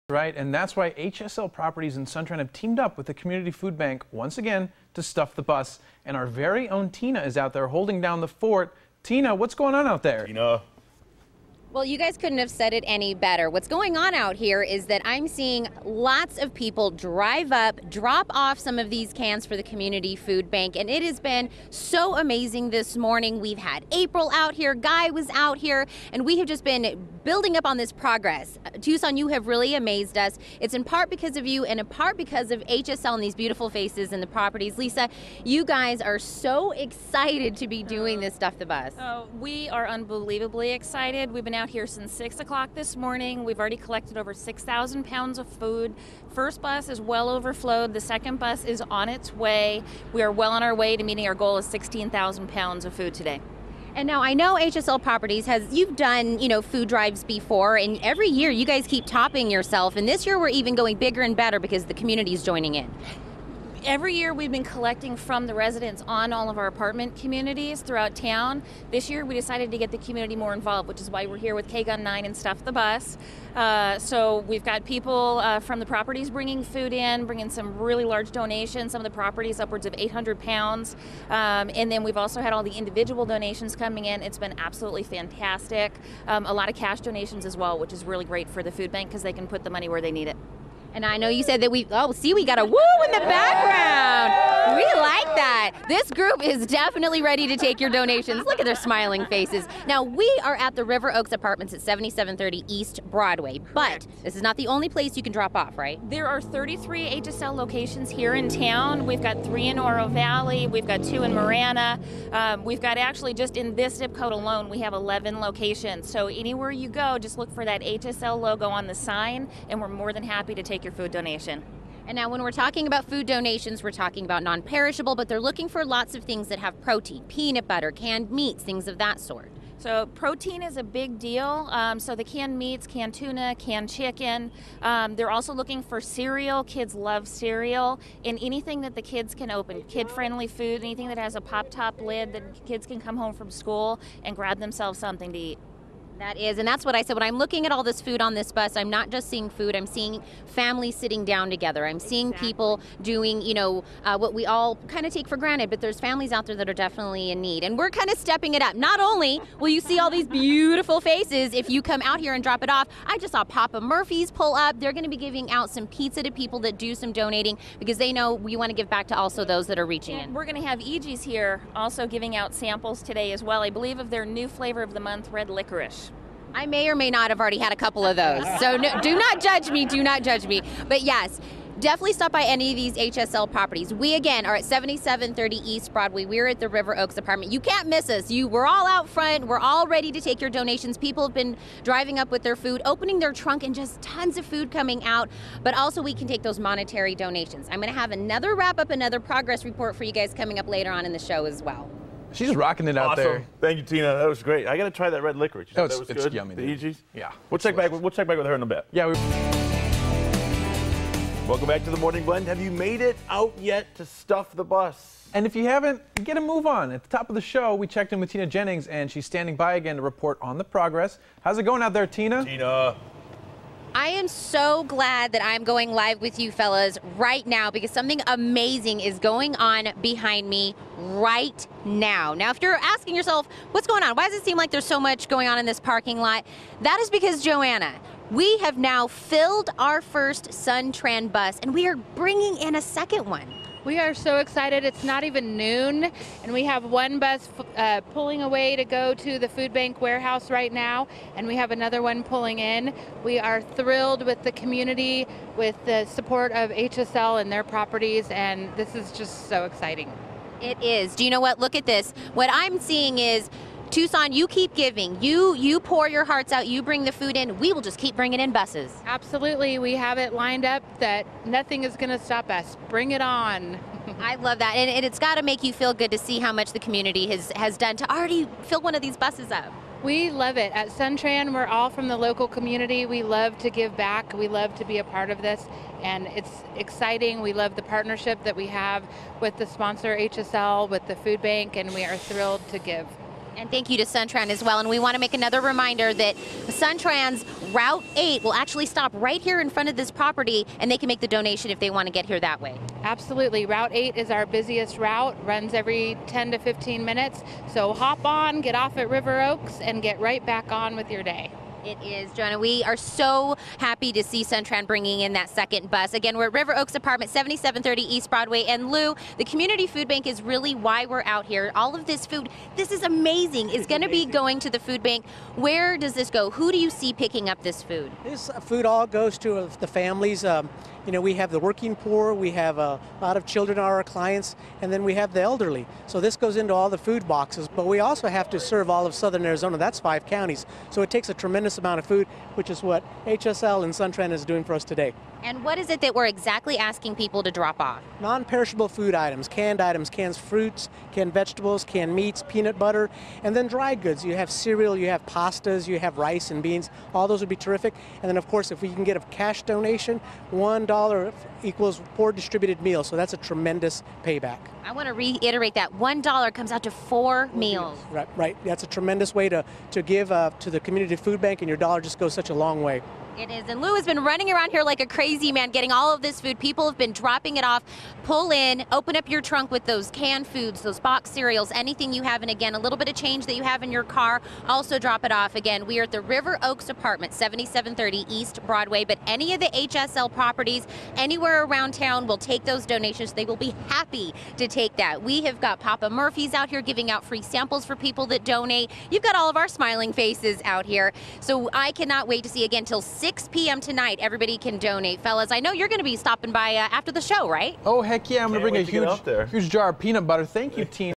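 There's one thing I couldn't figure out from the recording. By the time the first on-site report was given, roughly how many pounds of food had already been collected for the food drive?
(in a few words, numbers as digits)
over 6,000 pounds.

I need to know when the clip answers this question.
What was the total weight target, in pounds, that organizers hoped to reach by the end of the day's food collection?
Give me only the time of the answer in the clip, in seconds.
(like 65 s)
51 s.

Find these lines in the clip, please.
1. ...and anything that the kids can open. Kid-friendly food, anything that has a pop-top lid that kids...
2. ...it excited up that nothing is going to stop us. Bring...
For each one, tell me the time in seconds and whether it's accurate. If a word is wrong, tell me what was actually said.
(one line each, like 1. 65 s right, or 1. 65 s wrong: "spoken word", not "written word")
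1. 138 s right
2. 270 s wrong: "lined", not "excited".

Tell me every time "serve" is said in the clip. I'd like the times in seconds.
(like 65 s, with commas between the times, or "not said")
338 s.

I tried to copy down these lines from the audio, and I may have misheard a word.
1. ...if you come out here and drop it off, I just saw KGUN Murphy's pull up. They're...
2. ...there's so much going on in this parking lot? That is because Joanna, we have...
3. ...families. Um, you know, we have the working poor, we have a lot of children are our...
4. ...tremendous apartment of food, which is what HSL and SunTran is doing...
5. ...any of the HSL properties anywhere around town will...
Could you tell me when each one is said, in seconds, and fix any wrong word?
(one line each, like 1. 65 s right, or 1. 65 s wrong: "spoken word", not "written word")
1. 161 s wrong: "Papa", not "KGUN"
2. 234 s right
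3. 329 s right
4. 341 s wrong: "amount", not "apartment"
5. 389 s right.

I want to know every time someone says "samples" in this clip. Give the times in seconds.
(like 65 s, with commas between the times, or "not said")
172 s, 397 s.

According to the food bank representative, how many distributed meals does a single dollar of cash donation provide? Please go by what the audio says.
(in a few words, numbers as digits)
4.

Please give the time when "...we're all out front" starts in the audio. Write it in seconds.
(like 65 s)
188 s.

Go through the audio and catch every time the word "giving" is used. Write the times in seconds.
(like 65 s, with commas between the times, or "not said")
165 s, 172 s, 264 s, 396 s.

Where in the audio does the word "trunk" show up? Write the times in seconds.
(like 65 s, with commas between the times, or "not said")
193 s, 379 s.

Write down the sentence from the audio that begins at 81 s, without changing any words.
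Um, and then we've also had all the individual donations coming in.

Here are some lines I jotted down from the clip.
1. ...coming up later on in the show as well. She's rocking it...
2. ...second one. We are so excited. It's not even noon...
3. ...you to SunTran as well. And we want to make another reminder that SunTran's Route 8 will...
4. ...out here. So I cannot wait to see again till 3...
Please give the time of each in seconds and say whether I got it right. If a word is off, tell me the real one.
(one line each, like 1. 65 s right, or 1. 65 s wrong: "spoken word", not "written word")
1. 200 s right
2. 242 s right
3. 293 s right
4. 400 s wrong: "6", not "3".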